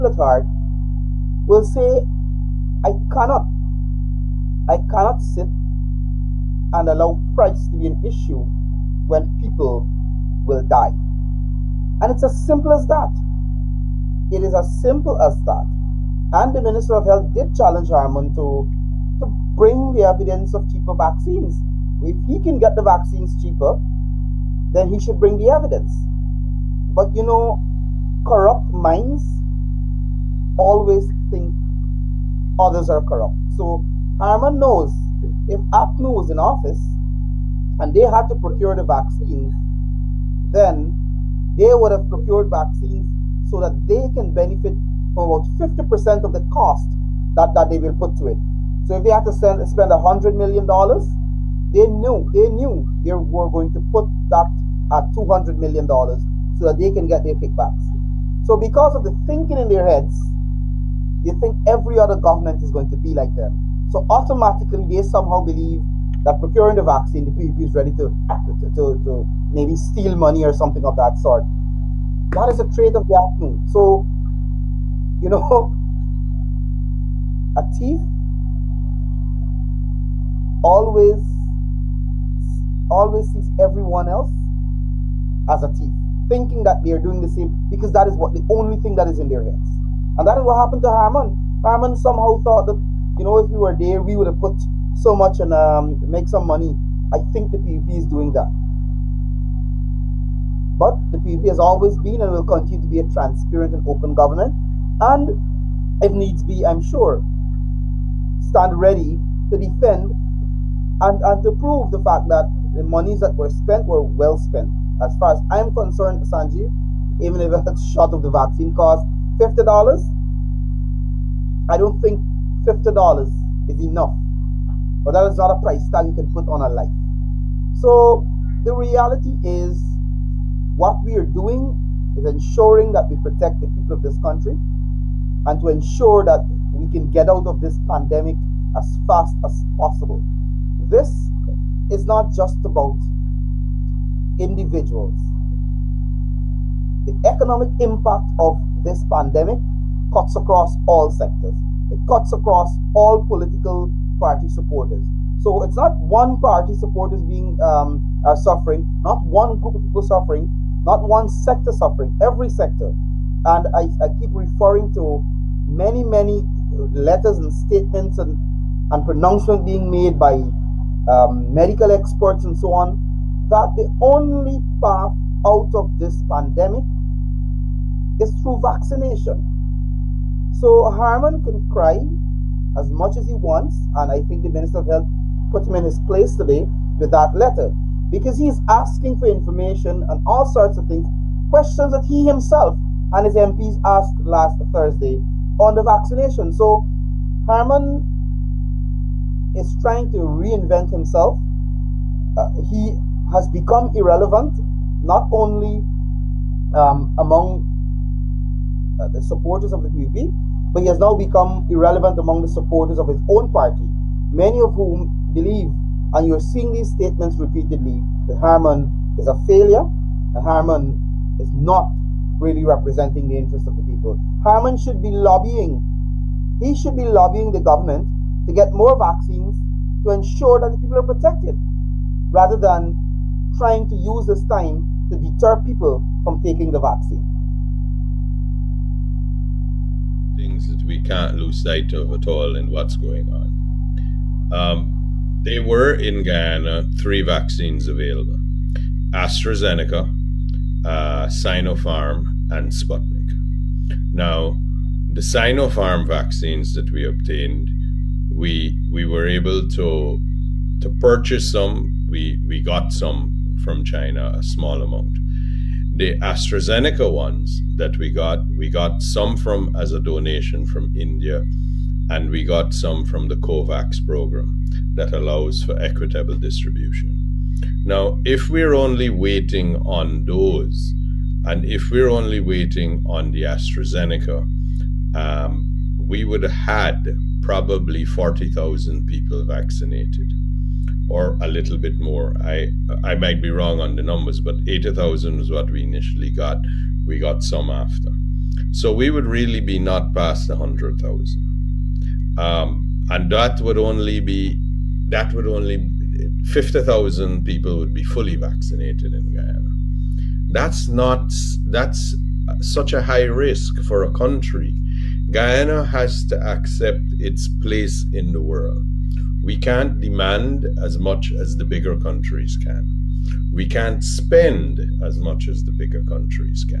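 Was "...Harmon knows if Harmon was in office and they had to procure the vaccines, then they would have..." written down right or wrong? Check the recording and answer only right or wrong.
wrong.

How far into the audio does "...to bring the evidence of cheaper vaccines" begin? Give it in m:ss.
0:19.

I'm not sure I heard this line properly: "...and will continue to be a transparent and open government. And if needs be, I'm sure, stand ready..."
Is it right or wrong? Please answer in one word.
right.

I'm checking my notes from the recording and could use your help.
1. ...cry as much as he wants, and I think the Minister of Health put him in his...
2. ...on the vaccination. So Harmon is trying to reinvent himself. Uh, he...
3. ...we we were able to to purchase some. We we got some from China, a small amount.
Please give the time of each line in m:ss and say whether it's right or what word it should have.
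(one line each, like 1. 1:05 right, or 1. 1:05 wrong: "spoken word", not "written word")
1. 3:01 right
2. 3:15 right
3. 4:18 right.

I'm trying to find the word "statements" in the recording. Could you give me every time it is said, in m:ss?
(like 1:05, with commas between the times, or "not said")
2:47, 3:36.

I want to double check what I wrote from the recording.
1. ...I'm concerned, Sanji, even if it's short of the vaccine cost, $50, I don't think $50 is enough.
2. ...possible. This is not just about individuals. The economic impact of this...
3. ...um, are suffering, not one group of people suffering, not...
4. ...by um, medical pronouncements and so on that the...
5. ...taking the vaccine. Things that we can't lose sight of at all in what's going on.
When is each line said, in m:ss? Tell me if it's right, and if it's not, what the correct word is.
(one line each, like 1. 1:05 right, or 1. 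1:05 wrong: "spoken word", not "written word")
1. 1:55 right
2. 2:19 right
3. 2:37 right
4. 2:50 wrong: "experts", not "pronouncements"
5. 3:56 right.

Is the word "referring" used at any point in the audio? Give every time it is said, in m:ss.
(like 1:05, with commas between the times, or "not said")
2:44.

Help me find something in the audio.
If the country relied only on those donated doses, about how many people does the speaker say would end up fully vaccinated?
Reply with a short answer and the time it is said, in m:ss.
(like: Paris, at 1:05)
50,000, at 5:06.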